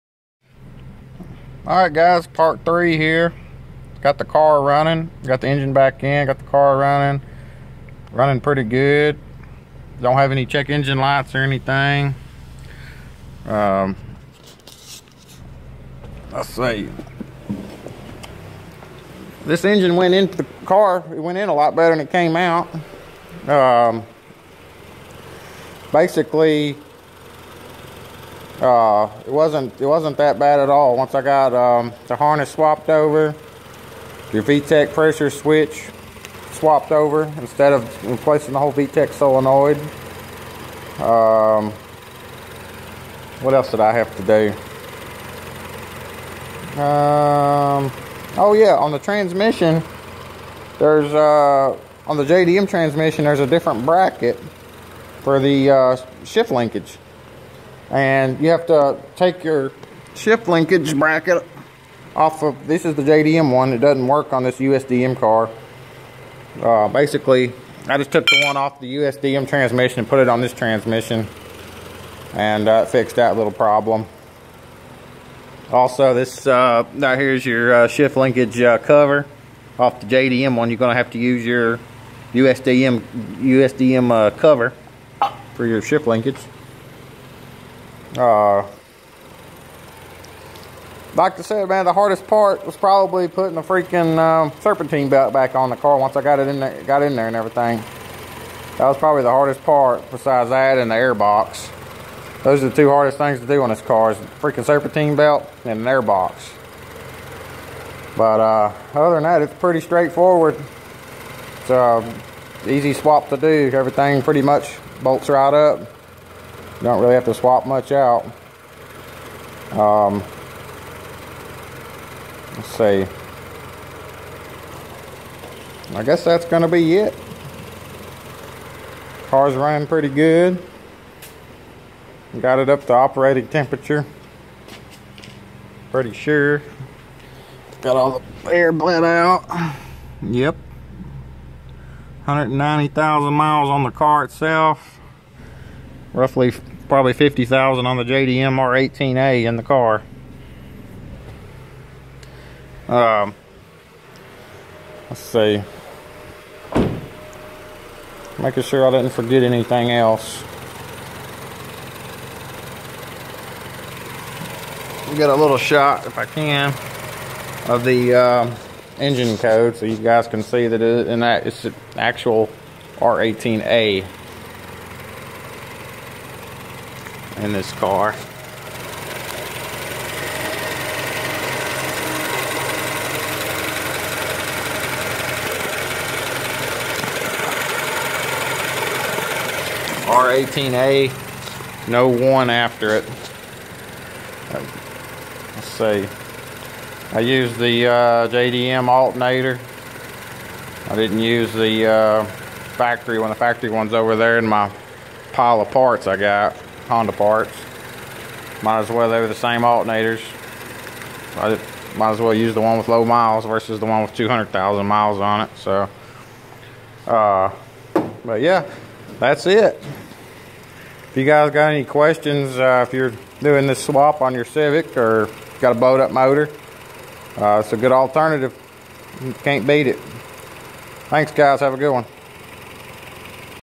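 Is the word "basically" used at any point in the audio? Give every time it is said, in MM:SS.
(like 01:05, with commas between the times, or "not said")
00:25, 01:06.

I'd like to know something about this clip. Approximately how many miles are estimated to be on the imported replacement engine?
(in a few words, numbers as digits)
50,000.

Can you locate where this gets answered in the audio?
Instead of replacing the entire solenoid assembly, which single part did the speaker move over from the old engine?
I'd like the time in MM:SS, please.
00:34.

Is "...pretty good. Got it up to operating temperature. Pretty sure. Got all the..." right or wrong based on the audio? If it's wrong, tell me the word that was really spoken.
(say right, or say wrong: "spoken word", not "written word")
right.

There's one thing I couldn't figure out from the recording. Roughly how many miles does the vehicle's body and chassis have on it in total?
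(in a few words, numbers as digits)
190,000.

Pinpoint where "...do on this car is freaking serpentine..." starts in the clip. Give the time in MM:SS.
01:43.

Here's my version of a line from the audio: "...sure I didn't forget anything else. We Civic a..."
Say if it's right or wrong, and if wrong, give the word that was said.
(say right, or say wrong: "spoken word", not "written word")
wrong: "Get", not "Civic".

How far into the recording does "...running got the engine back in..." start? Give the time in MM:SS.
00:04.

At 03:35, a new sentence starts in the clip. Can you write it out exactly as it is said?
So, uh, but yeah, that's it.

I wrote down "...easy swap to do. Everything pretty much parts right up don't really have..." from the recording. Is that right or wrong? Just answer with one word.
wrong.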